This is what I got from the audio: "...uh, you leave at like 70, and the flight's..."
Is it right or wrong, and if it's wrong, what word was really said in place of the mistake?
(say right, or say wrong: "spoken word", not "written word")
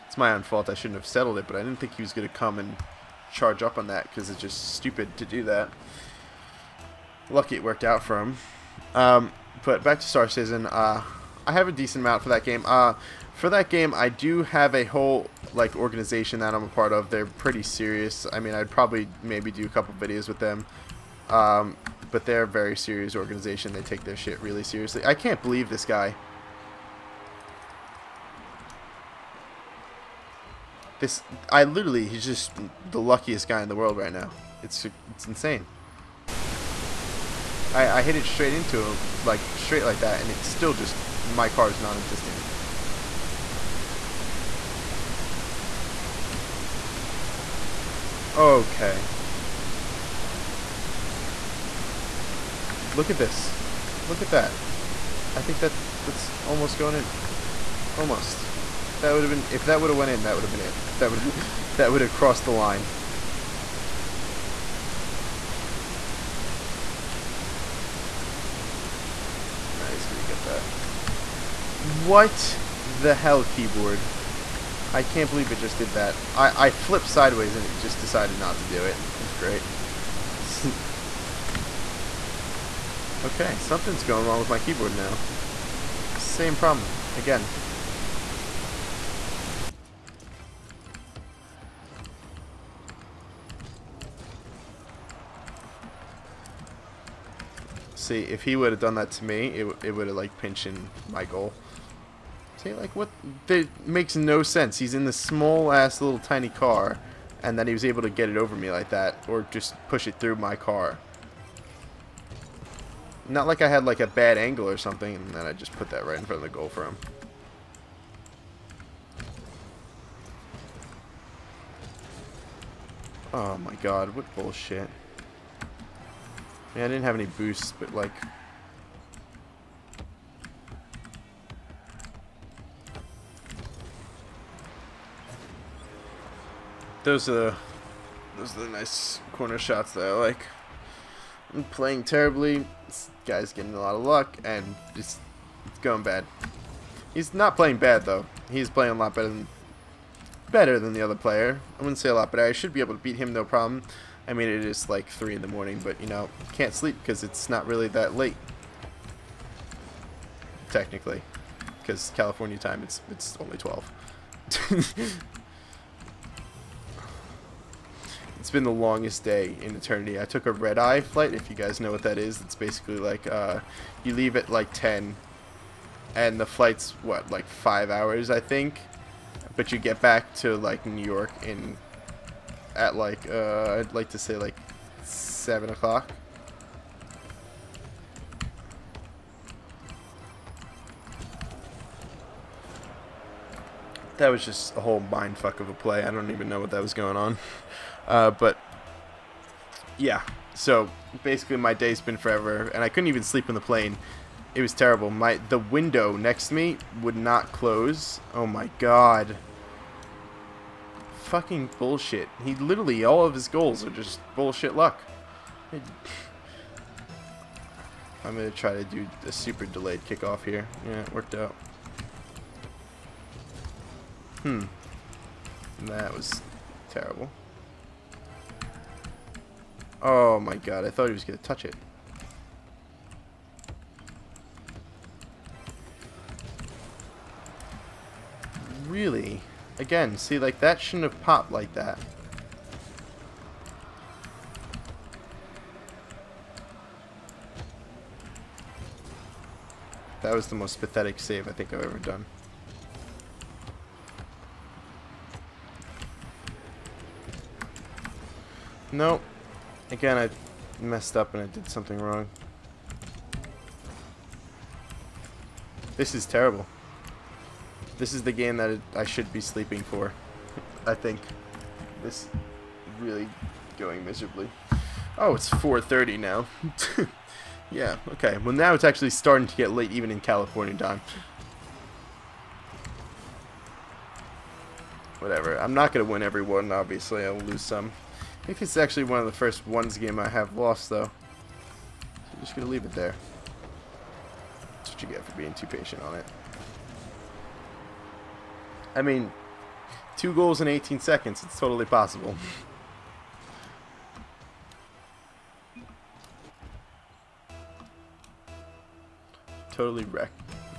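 wrong: "10", not "70".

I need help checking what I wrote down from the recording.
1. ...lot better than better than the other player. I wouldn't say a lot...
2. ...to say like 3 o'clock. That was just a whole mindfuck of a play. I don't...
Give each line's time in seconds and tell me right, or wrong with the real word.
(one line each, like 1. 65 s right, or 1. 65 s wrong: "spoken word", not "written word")
1. 148 s right
2. 184 s wrong: "7", not "3".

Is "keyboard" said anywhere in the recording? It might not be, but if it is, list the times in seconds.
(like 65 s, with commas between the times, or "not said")
73 s, 84 s.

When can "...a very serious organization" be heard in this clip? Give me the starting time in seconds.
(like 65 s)
22 s.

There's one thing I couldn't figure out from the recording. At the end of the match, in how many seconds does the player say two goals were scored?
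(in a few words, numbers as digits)
18.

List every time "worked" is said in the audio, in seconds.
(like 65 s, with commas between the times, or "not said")
7 s, 221 s.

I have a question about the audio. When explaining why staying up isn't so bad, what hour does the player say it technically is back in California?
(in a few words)
12.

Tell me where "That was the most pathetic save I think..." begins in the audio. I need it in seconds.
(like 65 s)
250 s.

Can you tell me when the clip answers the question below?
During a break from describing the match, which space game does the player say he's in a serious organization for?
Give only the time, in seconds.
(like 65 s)
10 s.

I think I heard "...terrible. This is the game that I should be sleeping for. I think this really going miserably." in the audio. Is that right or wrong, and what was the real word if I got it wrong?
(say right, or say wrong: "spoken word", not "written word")
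right.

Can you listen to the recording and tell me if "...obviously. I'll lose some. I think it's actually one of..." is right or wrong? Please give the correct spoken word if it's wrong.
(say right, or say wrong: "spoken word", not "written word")
right.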